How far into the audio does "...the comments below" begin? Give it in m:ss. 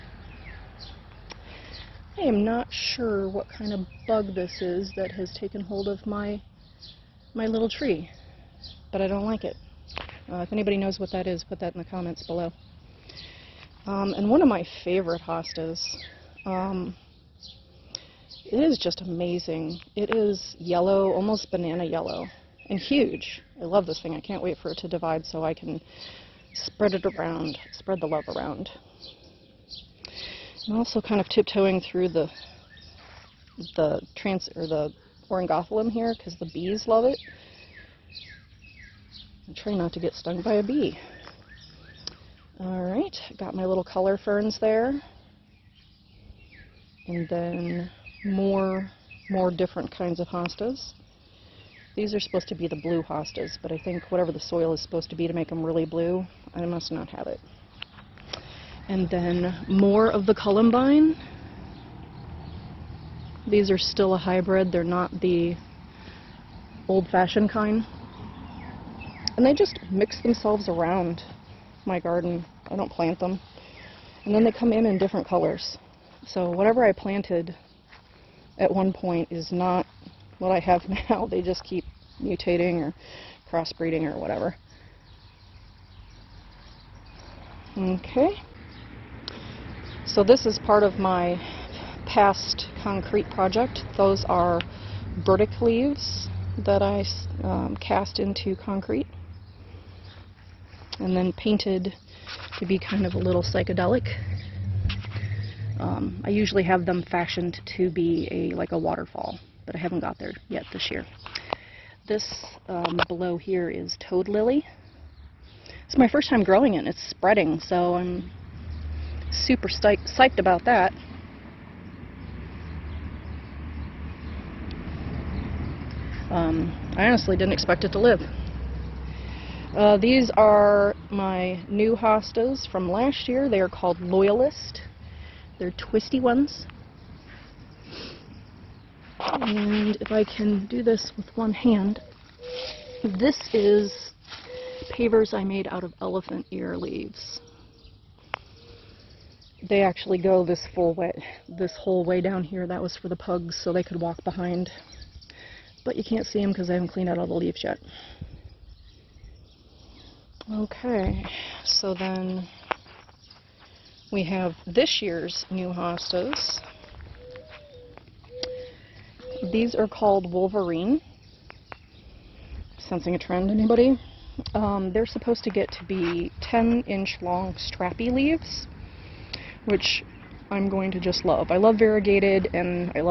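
0:11.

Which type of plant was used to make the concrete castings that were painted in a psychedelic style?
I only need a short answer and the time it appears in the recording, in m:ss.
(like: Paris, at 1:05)
Burdock leaves, at 1:35.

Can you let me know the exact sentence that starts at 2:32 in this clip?
That was for the pugs so they could walk behind.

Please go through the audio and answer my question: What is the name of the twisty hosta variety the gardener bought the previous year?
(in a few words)
Loyalist.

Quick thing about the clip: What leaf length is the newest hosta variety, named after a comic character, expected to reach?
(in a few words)
10 inches.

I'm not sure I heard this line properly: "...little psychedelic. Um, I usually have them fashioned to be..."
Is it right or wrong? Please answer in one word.
right.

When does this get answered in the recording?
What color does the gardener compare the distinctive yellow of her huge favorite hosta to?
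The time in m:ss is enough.
0:21.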